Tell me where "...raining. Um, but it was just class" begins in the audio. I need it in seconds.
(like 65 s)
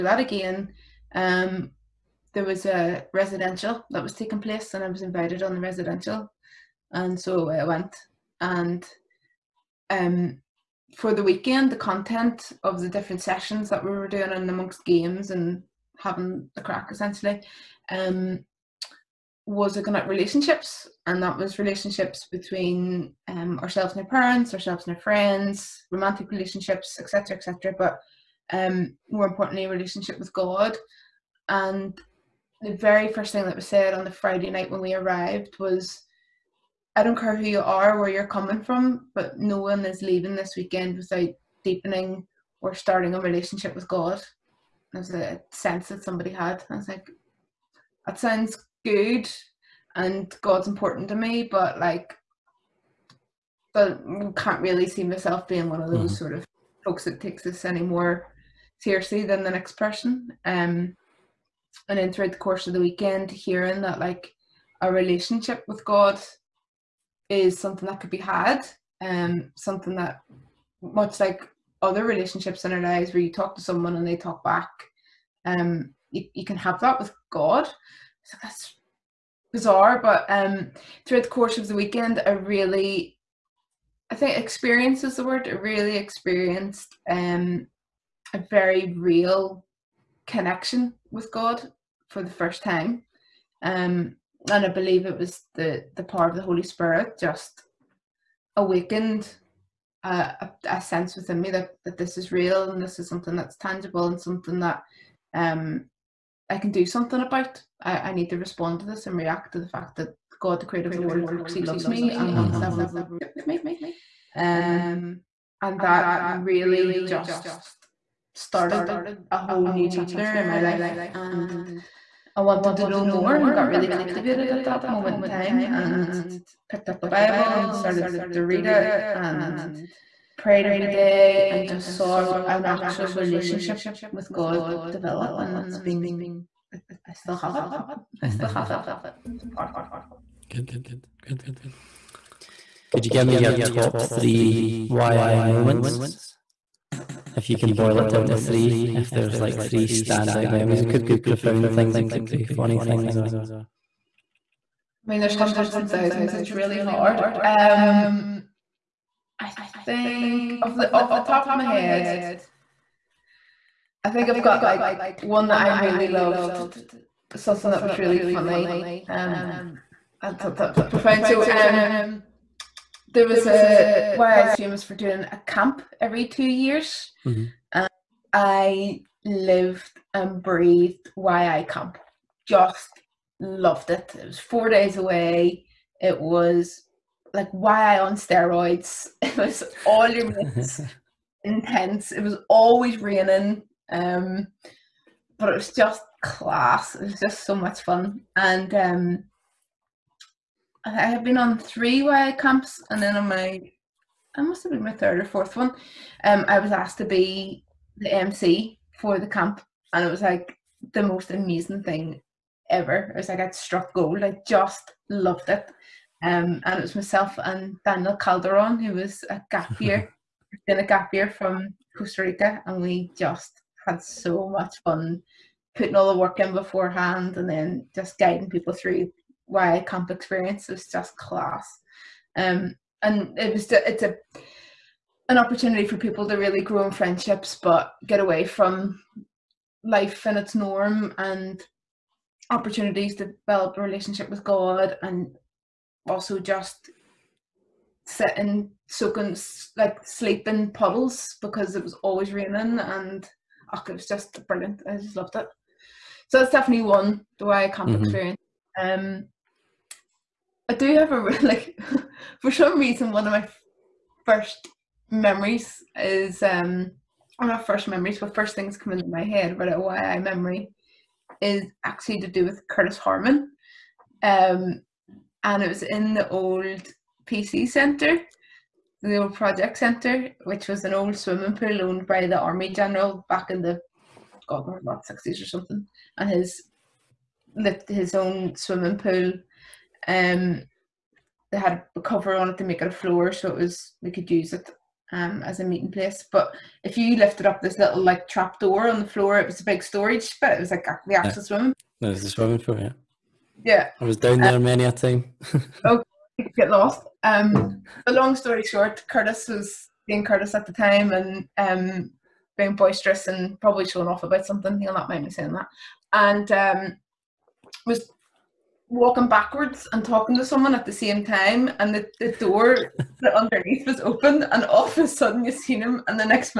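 192 s.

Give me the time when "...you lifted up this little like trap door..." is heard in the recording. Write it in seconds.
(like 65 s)
296 s.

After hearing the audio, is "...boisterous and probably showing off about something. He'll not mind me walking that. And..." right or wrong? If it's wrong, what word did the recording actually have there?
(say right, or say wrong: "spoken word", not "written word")
wrong: "saying", not "walking".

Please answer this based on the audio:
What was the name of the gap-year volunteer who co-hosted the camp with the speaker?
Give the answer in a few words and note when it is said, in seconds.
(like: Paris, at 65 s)
Daniel Calderon, at 217 s.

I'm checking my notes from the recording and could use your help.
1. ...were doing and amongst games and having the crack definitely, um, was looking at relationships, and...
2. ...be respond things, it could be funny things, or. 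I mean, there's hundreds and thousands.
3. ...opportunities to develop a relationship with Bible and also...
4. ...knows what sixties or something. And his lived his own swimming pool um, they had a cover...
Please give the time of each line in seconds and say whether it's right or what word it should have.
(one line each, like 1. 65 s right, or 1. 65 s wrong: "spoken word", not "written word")
1. 13 s wrong: "essentially", not "definitely"
2. 151 s wrong: "profound", not "respond"
3. 242 s wrong: "God", not "Bible"
4. 284 s right.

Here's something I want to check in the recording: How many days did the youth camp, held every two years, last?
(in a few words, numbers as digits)
4.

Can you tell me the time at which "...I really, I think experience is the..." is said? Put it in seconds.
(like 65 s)
82 s.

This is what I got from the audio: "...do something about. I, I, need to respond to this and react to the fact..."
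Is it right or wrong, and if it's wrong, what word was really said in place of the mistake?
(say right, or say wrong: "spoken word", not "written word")
right.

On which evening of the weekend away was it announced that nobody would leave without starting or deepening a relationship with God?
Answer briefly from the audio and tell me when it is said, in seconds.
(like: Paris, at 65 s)
Friday, at 34 s.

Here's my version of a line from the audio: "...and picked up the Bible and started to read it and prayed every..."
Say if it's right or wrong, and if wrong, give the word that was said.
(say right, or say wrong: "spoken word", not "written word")
right.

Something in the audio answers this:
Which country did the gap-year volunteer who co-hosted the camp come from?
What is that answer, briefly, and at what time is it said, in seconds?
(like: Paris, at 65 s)
Costa Rica, at 221 s.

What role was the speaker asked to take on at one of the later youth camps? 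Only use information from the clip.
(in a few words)
MC.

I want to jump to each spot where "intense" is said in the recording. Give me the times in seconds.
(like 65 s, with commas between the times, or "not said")
191 s.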